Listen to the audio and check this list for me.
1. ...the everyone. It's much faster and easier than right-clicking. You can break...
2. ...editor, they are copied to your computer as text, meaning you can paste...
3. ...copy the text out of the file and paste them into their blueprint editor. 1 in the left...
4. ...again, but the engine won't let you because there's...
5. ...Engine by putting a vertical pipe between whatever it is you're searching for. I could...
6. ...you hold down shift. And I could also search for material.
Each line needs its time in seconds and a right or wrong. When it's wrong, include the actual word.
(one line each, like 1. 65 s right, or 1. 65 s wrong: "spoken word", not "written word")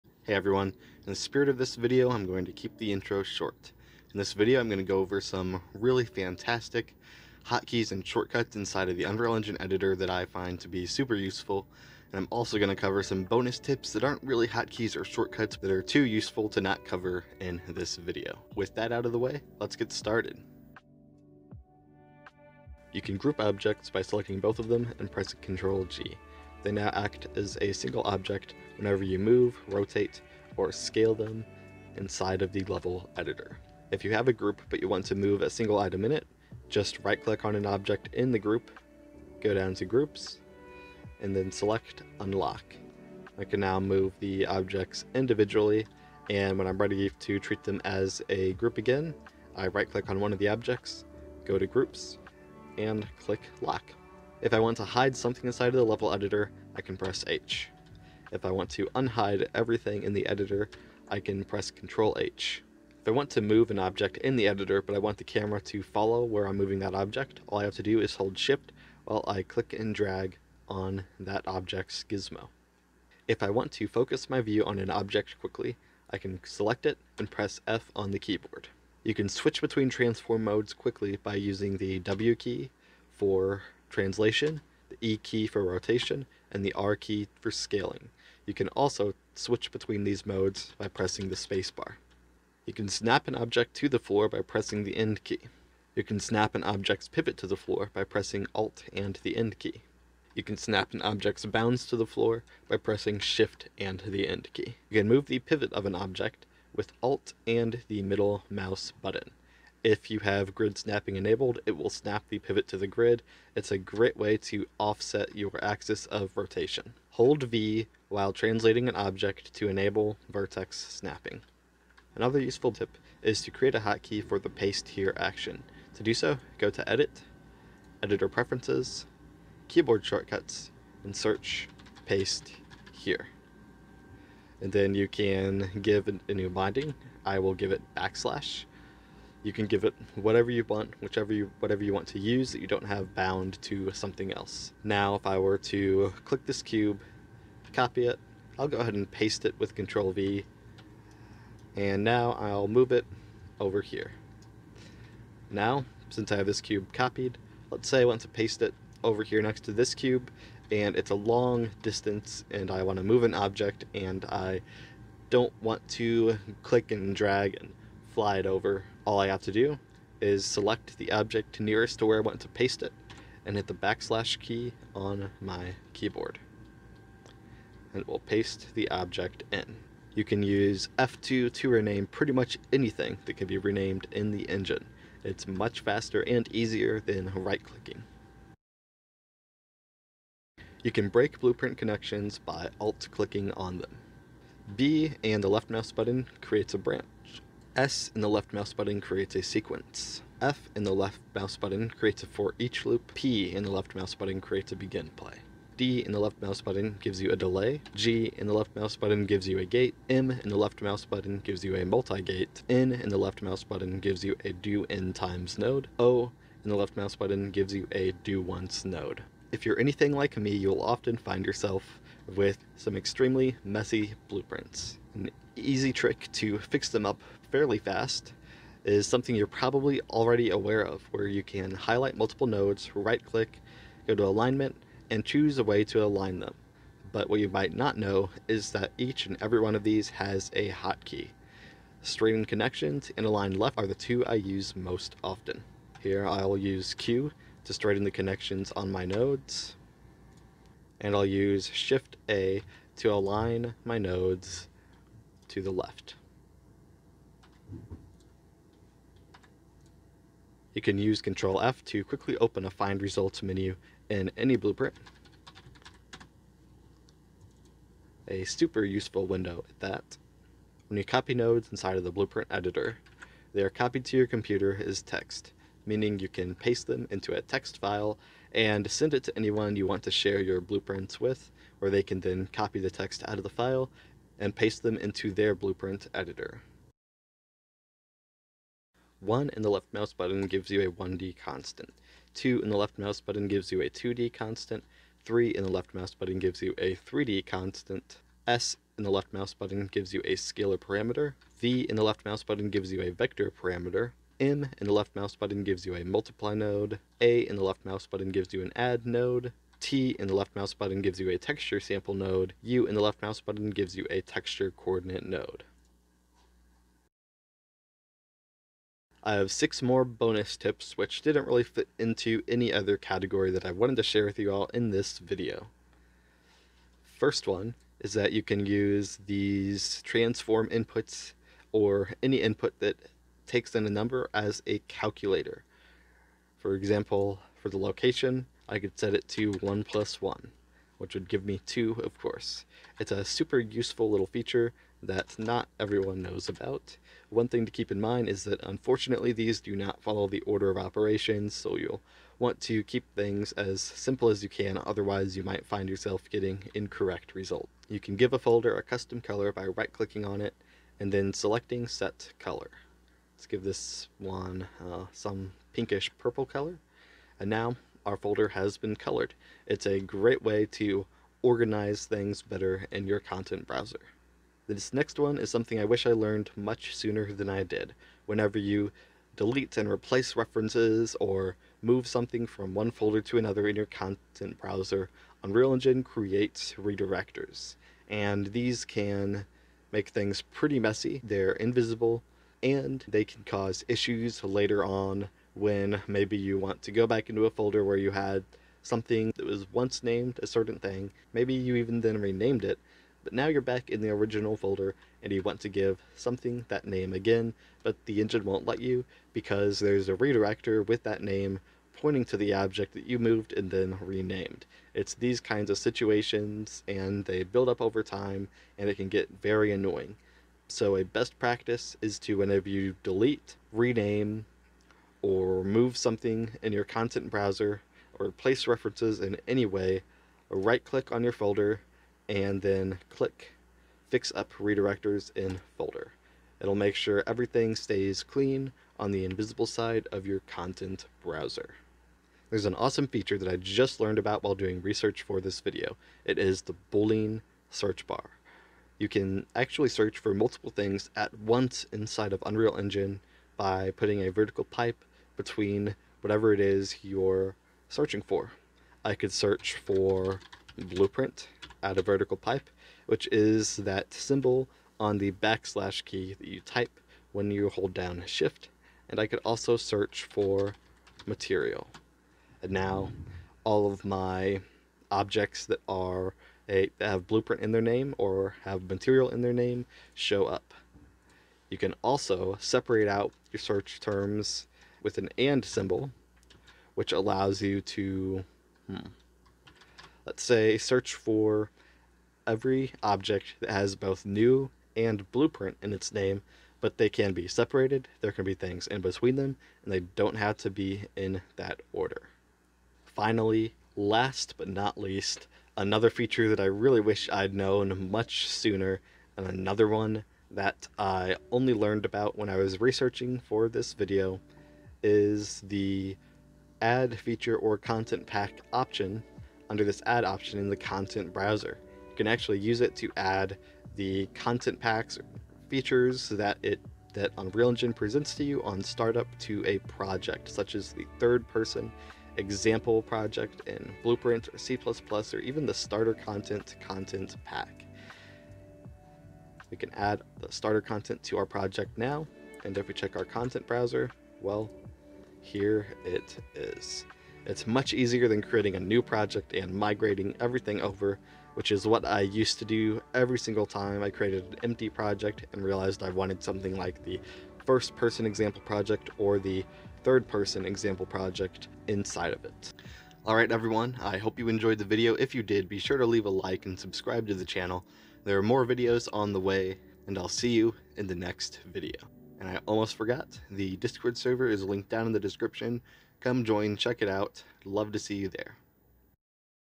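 1. 184 s wrong: "engine", not "everyone"
2. 272 s right
3. 282 s right
4. 407 s right
5. 452 s right
6. 467 s right.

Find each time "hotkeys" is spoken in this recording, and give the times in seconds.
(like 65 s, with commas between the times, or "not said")
7 s, 14 s, 123 s, 240 s.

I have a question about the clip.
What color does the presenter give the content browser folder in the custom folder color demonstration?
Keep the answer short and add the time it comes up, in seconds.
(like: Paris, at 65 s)
pinkish purple, at 365 s.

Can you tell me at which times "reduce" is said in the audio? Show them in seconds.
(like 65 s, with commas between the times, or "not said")
not said.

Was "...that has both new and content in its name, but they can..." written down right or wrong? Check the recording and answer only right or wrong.
wrong.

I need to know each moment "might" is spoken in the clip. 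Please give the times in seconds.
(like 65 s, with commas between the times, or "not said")
237 s, 355 s.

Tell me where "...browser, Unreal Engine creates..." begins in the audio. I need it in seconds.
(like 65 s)
384 s.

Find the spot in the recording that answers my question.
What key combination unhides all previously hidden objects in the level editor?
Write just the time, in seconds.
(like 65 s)
61 s.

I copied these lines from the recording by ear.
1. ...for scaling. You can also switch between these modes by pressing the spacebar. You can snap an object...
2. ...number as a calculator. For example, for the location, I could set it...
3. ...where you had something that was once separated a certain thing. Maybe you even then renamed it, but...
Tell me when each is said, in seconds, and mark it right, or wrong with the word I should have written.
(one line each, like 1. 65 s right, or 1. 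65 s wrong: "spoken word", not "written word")
1. 87 s right
2. 333 s right
3. 397 s wrong: "named", not "separated".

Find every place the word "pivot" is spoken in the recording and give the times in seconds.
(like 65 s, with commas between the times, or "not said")
97 s, 105 s, 112 s.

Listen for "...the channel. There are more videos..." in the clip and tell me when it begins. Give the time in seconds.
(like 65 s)
567 s.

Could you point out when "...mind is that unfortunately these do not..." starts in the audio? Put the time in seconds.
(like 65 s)
347 s.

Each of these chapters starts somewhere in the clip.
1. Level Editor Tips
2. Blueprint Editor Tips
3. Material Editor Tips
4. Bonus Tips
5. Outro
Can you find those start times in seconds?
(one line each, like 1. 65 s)
1. 21 s
2. 189 s
3. 287 s
4. 318 s
5. 563 s.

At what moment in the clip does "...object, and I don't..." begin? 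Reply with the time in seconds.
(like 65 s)
163 s.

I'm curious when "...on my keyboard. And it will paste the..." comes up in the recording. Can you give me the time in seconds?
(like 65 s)
174 s.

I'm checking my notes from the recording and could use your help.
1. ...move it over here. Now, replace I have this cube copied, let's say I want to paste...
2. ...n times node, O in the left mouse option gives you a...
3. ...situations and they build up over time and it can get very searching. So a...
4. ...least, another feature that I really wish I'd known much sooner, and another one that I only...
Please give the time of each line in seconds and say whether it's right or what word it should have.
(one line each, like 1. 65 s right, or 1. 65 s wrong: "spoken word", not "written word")
1. 152 s wrong: "since", not "replace"
2. 214 s wrong: "button", not "option"
3. 415 s wrong: "annoying", not "searching"
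4. 504 s right.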